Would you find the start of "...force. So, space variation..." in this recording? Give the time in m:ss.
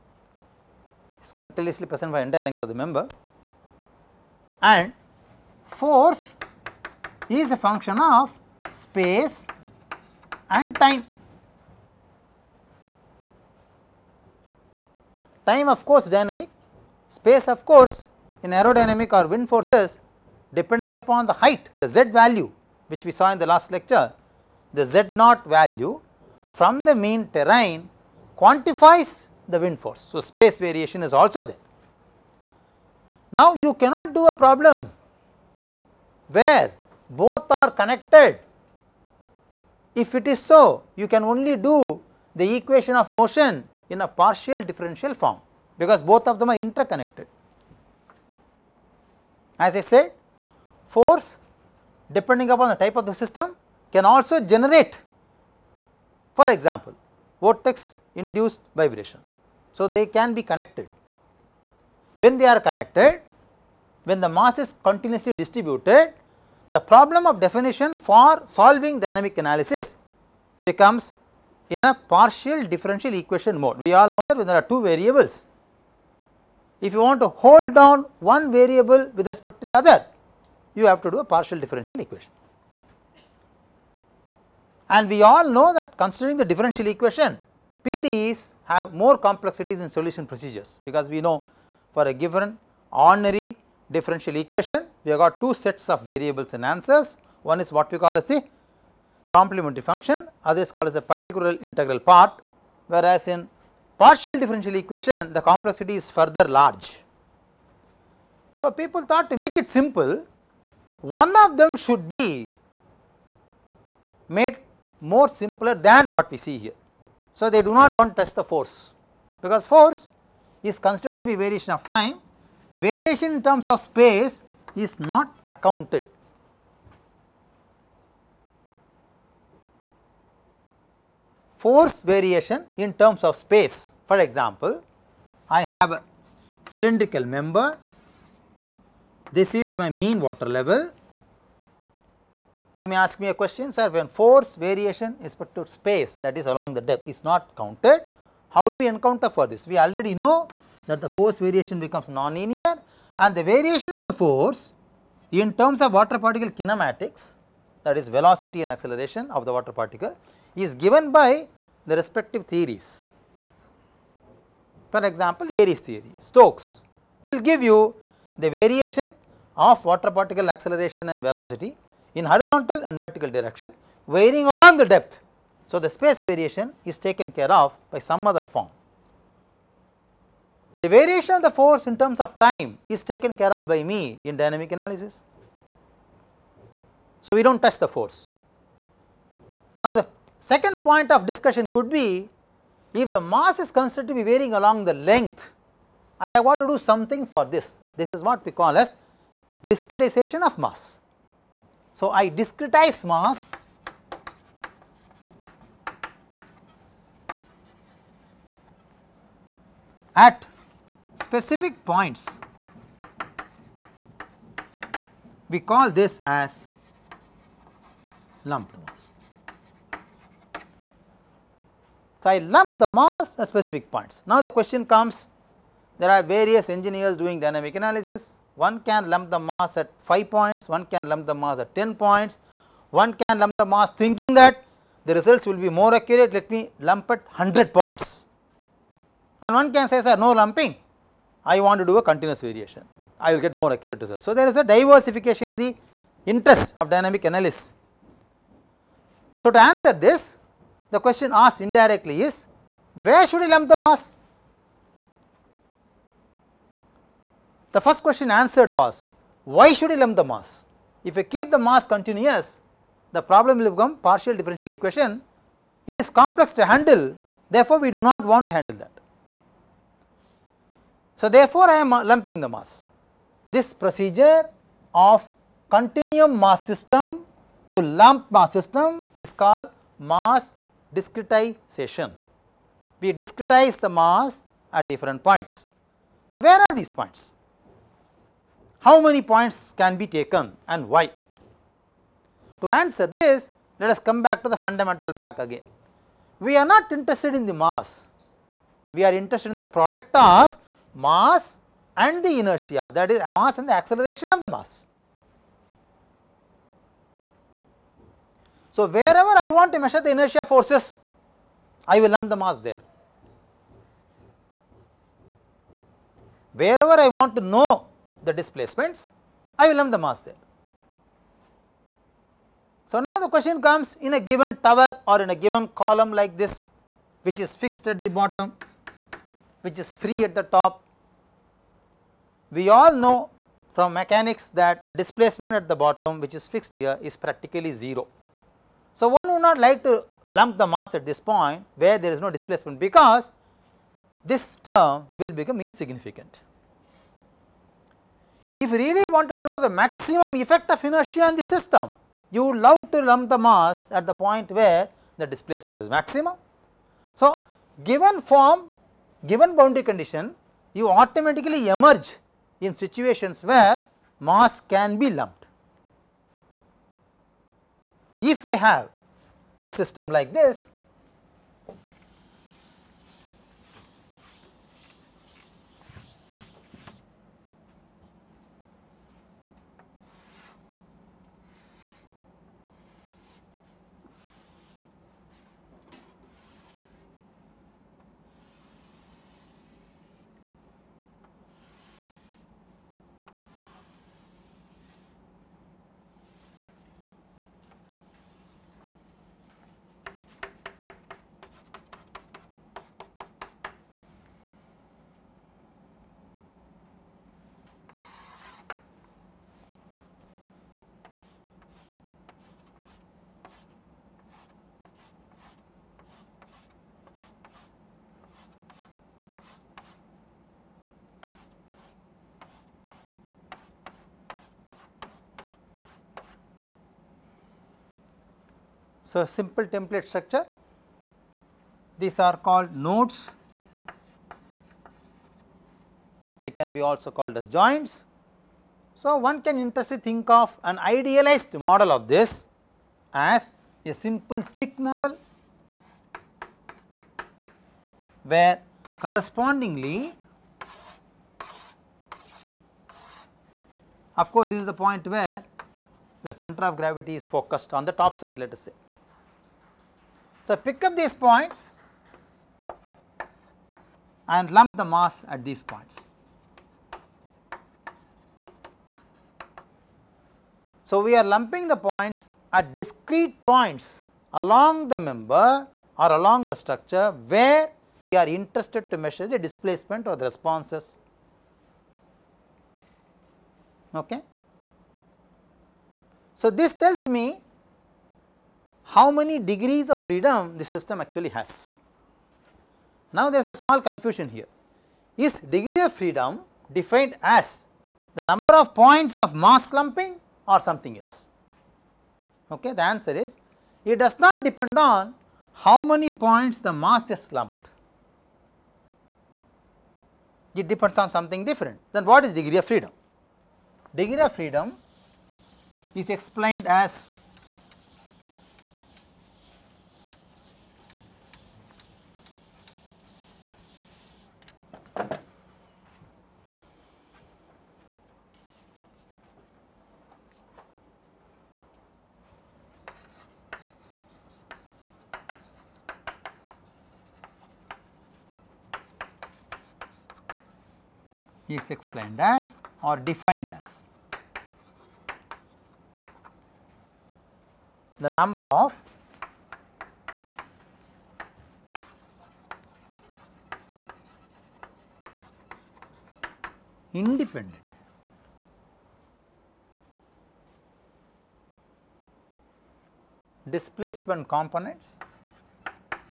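0:29.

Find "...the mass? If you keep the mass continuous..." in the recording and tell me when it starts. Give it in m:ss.
4:20.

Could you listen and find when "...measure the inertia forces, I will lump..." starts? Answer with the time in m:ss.
5:09.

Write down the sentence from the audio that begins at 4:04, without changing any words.
So, there is a diversification in the interest of dynamic analysis.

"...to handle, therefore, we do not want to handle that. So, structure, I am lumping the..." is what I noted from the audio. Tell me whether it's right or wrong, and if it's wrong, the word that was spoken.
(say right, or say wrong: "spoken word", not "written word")
wrong: "therefore", not "structure".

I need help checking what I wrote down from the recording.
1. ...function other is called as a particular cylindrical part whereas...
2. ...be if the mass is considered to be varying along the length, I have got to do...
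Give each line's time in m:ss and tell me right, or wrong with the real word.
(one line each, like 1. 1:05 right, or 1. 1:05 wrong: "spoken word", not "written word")
1. 1:39 wrong: "integral", not "cylindrical"
2. 3:11 right.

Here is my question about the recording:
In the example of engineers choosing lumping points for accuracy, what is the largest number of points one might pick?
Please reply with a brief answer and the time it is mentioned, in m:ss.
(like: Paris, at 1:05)
100, at 3:57.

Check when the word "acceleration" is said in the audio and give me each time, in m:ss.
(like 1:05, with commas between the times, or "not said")
2:38, 2:50, 5:03.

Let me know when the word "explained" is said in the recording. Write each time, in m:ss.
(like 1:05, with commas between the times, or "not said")
8:36, 9:01.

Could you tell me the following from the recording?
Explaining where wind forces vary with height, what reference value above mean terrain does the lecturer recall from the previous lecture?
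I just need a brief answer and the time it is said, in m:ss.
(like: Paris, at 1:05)
z naught, at 0:24.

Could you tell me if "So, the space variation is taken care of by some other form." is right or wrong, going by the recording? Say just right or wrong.
right.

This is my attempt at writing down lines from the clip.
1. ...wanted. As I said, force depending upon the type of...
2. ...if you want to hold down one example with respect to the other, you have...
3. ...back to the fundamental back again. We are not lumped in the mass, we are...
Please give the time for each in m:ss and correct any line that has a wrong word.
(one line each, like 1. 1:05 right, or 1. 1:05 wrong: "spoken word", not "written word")
1. 0:46 wrong: "interconnected", not "wanted"
2. 1:16 wrong: "variable", not "example"
3. 4:54 wrong: "interested", not "lumped".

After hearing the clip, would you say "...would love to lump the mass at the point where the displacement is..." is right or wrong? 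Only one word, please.
right.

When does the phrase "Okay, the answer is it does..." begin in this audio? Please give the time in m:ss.
8:22.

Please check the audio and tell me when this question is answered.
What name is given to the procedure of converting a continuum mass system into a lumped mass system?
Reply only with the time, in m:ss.
4:39.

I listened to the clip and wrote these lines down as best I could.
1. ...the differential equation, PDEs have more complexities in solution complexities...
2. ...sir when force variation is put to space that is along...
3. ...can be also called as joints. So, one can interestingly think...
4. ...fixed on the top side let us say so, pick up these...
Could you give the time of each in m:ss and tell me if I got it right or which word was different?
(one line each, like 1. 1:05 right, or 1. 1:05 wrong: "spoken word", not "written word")
1. 1:26 wrong: "procedures", not "complexities"
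2. 2:23 right
3. 7:16 right
4. 7:37 wrong: "focused", not "fixed".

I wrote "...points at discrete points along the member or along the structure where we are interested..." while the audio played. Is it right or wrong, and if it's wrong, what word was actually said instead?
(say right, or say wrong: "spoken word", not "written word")
right.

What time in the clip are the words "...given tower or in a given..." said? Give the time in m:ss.
5:24.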